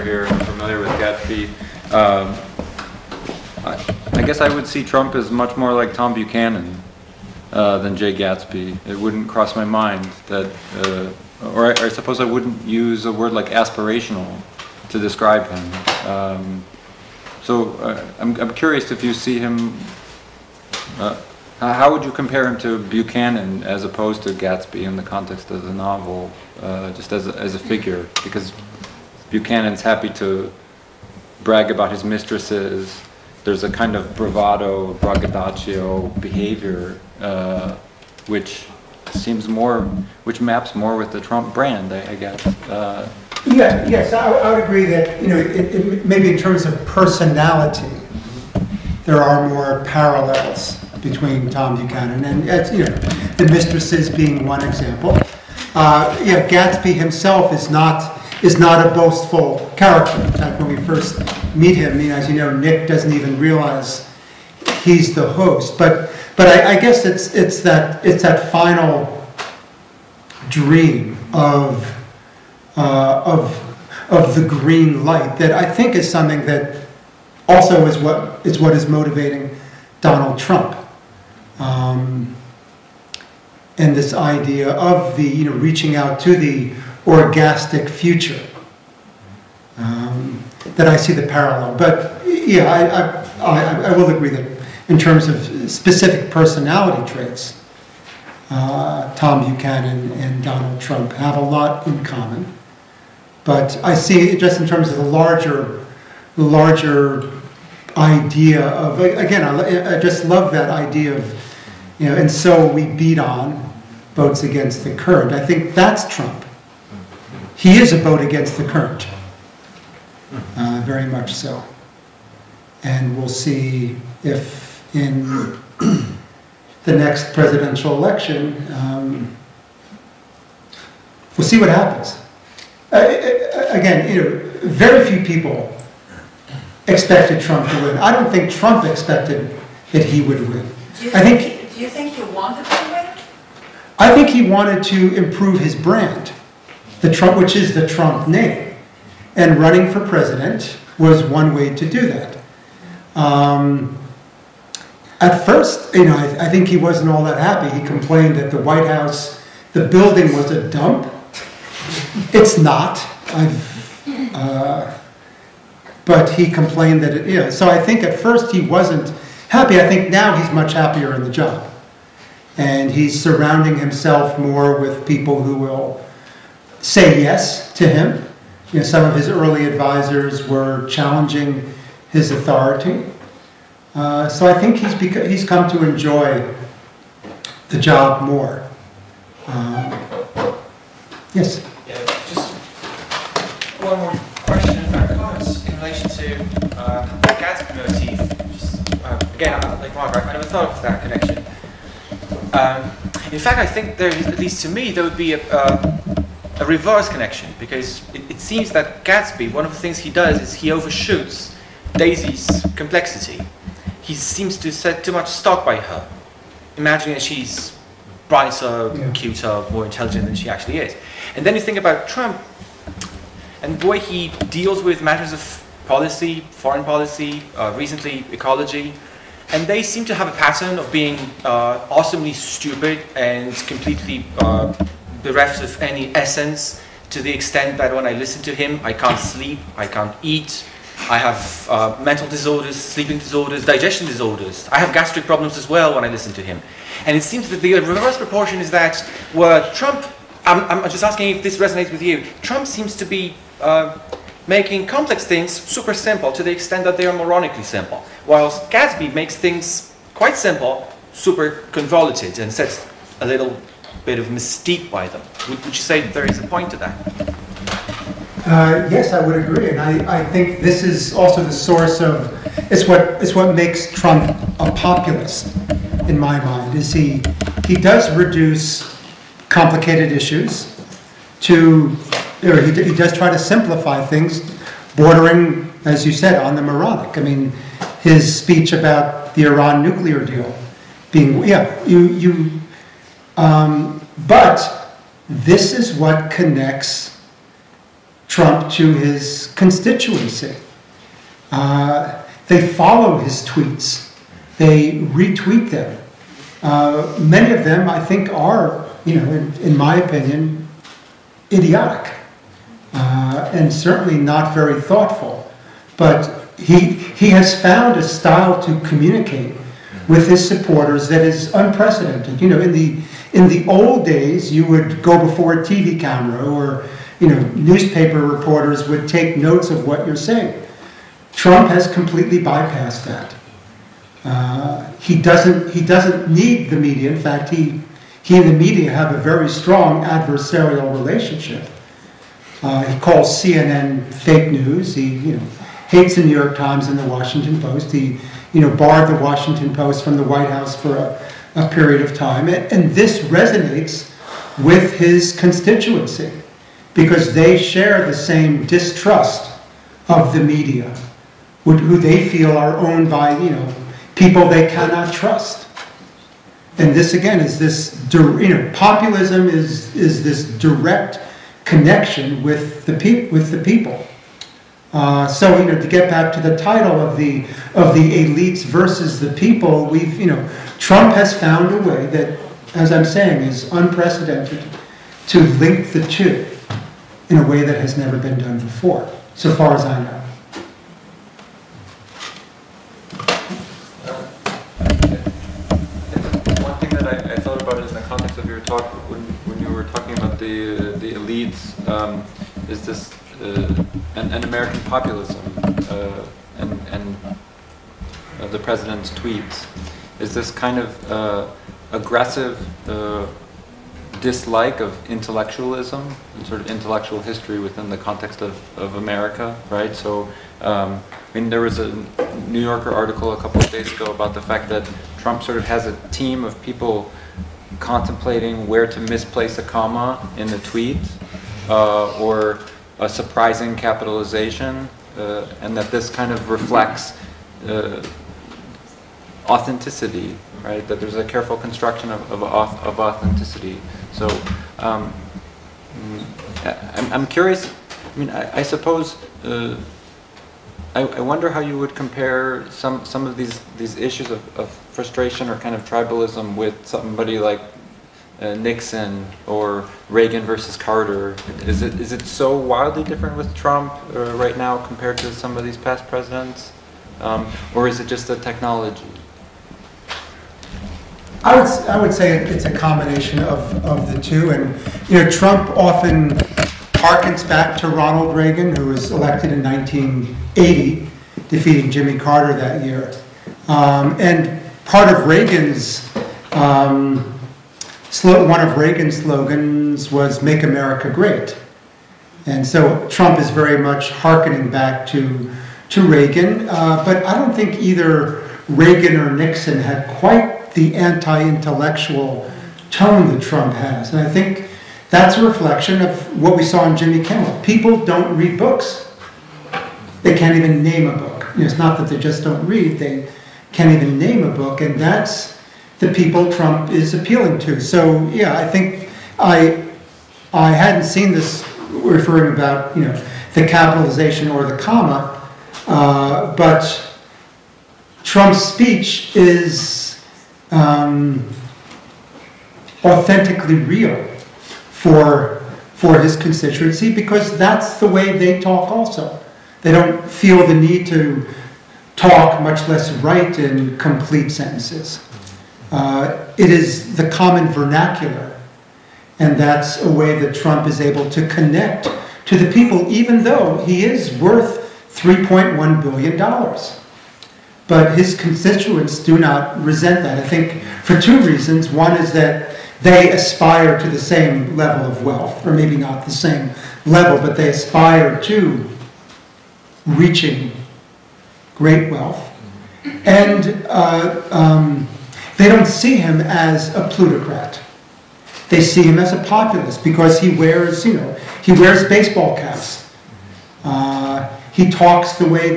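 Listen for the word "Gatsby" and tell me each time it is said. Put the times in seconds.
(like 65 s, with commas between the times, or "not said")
0 s, 8 s, 24 s, 56 s, 197 s, 209 s, 258 s.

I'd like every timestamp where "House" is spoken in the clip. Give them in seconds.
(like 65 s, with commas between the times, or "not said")
158 s, 350 s.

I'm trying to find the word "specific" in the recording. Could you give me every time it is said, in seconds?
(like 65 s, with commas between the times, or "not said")
95 s.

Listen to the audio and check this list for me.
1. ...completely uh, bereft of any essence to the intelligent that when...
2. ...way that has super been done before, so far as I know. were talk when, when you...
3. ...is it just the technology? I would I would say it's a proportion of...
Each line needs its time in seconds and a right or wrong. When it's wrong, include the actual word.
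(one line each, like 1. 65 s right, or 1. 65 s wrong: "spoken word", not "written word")
1. 233 s wrong: "extent", not "intelligent"
2. 387 s wrong: "never", not "super"
3. 467 s wrong: "combination", not "proportion".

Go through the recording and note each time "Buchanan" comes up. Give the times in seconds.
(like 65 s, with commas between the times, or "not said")
6 s, 22 s, 29 s, 51 s, 99 s.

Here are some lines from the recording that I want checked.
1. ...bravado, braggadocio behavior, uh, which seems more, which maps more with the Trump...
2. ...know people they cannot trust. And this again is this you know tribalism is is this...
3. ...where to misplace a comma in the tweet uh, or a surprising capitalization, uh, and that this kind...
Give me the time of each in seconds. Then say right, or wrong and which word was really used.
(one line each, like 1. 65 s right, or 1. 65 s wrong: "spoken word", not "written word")
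1. 34 s right
2. 363 s wrong: "populism", not "tribalism"
3. 428 s right.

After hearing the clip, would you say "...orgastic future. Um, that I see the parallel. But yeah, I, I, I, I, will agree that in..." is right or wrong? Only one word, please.
right.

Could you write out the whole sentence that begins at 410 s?
Is this kind of uh, aggressive uh, dislike of intellectualism and sort of intellectual history within the context of, of America, right?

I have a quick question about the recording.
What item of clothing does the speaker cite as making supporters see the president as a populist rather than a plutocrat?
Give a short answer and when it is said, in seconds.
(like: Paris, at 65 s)
Baseball caps, at 582 s.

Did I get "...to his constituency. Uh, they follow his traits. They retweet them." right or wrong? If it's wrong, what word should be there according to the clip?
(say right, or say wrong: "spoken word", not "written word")
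wrong: "tweets", not "traits".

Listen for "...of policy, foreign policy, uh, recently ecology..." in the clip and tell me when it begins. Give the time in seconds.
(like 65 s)
225 s.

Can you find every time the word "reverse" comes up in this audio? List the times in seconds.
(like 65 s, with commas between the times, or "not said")
206 s, 247 s.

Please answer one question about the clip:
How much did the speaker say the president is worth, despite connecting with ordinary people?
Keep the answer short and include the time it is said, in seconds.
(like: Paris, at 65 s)
$3.1 billion, at 555 s.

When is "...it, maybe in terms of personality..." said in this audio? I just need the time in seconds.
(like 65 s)
45 s.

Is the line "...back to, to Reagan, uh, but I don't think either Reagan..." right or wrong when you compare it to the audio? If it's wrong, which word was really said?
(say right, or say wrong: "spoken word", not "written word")
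right.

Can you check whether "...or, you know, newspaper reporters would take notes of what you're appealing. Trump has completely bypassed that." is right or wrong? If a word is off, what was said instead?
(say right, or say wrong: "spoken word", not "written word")
wrong: "saying", not "appealing".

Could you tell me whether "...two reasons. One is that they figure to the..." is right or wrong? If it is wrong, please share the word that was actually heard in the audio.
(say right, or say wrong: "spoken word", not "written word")
wrong: "aspire", not "figure".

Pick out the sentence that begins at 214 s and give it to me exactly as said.
He seems to set too much stock by her, imagining that she's brighter, yeah.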